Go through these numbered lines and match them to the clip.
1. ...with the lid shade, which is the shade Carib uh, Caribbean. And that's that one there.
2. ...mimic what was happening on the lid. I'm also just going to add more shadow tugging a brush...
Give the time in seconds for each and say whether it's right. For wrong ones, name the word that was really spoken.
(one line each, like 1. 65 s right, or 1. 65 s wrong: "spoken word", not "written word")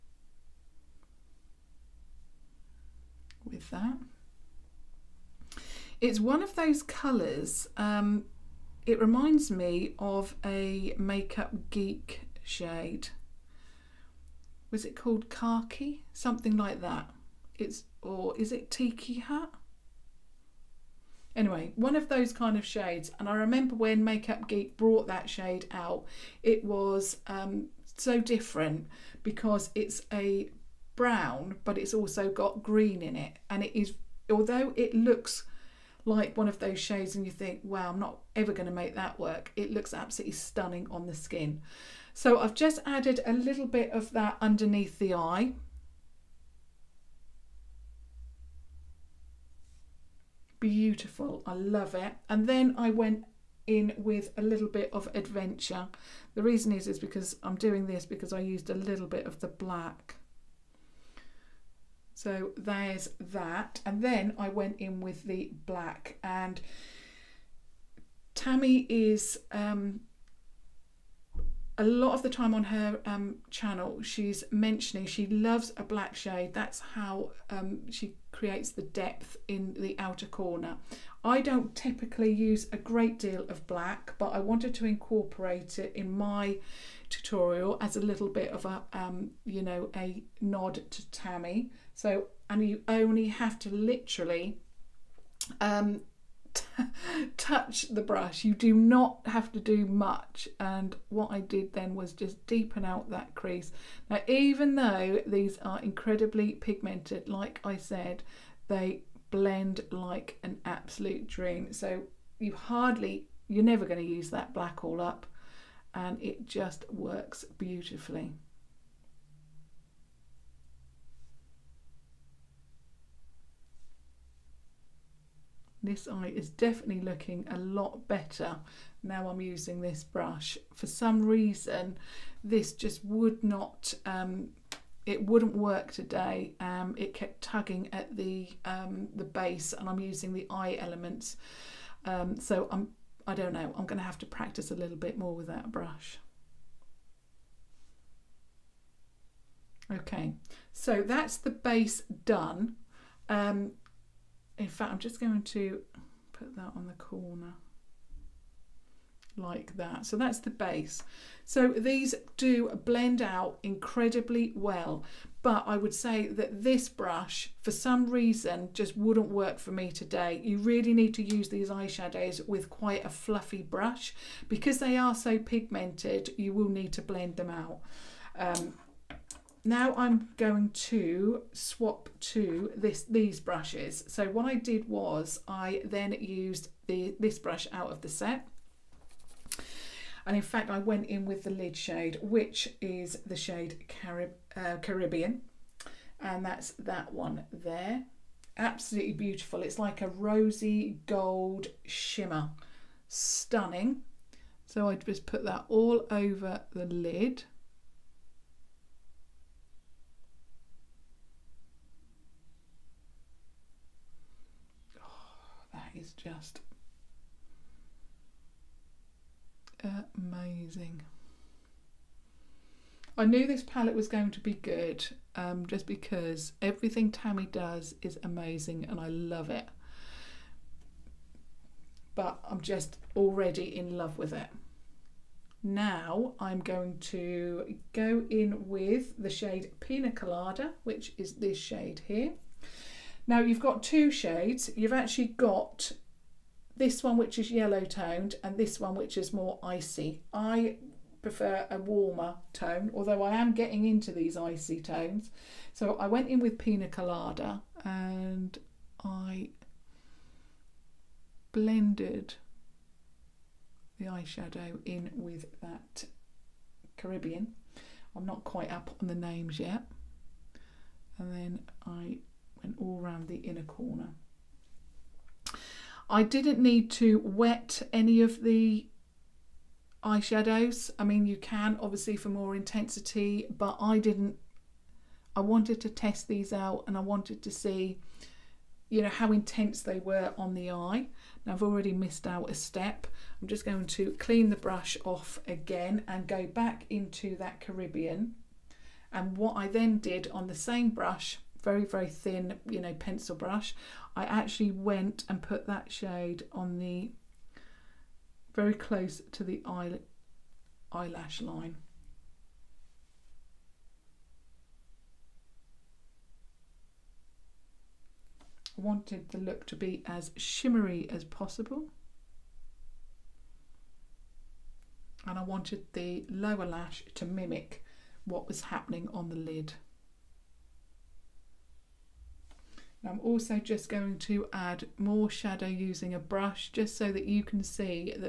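1. 191 s right
2. 327 s wrong: "using", not "tugging".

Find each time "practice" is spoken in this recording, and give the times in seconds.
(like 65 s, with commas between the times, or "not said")
144 s.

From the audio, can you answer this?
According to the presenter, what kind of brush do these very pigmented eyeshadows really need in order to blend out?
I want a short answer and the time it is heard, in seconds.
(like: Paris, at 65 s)
a fluffy brush, at 172 s.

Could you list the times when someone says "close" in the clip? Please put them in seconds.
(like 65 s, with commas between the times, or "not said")
308 s.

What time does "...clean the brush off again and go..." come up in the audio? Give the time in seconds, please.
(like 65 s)
294 s.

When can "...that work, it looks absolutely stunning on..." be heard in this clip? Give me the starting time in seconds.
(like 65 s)
38 s.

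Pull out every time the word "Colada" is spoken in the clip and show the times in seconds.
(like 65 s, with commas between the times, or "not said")
240 s, 256 s.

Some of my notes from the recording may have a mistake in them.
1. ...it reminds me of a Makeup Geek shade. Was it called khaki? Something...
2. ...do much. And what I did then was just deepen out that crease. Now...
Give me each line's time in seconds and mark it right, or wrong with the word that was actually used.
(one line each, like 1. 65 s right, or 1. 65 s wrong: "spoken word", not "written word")
1. 8 s right
2. 99 s right.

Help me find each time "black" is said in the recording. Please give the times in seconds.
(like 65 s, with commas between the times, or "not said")
59 s, 65 s, 75 s, 83 s, 114 s.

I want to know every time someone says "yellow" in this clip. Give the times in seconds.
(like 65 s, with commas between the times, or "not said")
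247 s.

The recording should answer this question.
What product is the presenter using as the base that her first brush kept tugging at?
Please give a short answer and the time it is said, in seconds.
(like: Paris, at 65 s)
eye elements, at 140 s.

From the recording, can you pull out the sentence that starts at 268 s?
I'm not quite up on the names yet.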